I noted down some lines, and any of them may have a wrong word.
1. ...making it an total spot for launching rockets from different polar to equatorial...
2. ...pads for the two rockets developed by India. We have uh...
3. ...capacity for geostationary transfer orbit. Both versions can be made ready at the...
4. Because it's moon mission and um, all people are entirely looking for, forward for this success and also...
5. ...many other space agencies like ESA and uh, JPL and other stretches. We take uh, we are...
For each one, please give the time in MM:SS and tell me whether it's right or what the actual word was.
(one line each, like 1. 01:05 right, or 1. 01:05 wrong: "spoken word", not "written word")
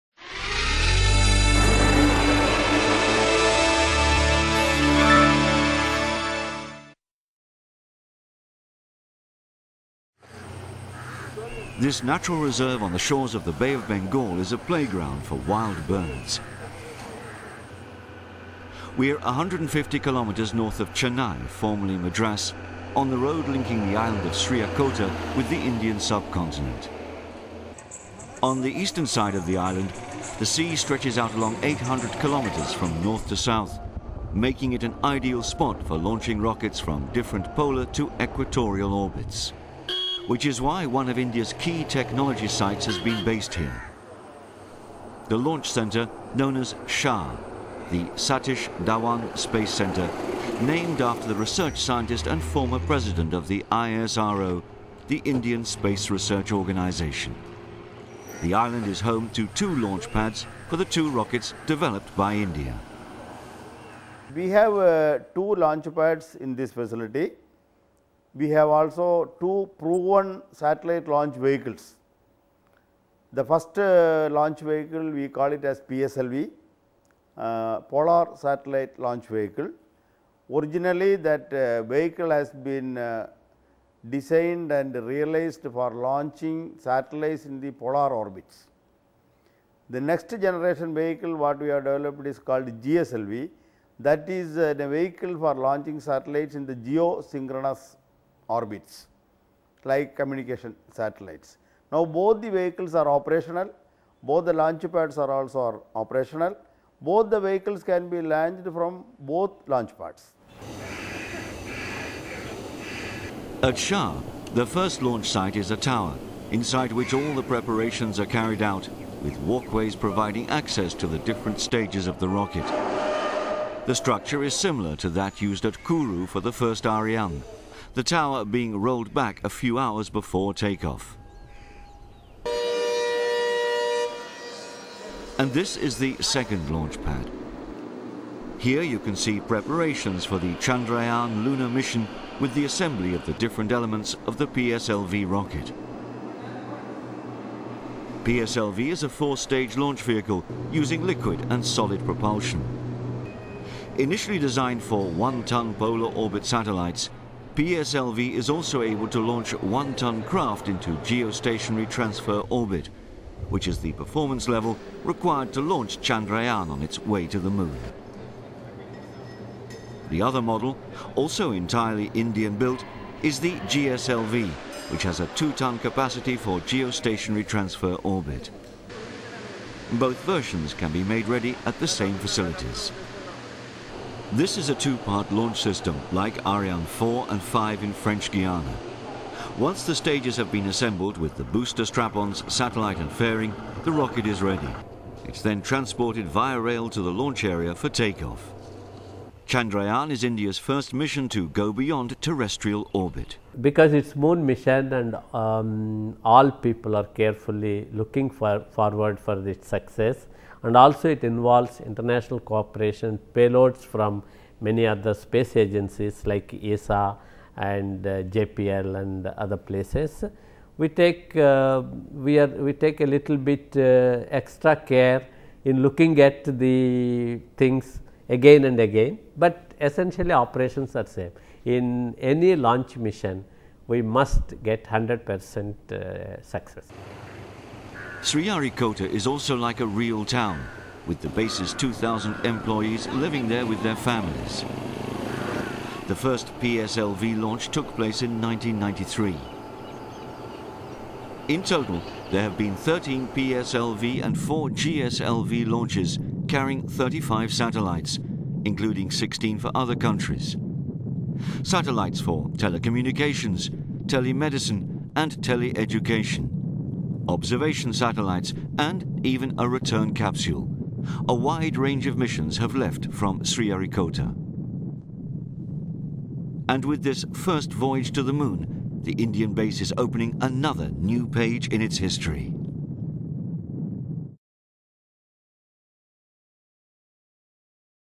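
1. 00:34 wrong: "ideal", not "total"
2. 01:00 right
3. 02:55 right
4. 03:23 wrong: "carefully", not "entirely"
5. 03:34 wrong: "places", not "stretches".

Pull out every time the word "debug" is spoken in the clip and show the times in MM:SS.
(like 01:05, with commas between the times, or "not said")
not said.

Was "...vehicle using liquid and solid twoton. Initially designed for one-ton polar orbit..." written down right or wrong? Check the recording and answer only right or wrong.
wrong.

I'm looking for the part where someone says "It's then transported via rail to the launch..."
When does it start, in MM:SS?
03:15.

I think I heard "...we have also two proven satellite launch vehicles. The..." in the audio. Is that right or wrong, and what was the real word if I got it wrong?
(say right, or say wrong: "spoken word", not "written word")
right.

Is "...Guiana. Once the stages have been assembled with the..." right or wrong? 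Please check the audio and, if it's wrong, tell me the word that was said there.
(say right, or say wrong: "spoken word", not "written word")
right.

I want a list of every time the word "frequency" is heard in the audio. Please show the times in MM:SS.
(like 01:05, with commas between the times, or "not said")
not said.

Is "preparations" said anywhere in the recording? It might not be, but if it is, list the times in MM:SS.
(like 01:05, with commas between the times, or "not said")
01:57, 02:19.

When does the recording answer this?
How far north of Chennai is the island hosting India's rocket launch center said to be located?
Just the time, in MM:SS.
00:19.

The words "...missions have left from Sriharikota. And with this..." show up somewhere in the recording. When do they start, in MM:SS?
04:32.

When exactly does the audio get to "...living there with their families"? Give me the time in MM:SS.
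04:03.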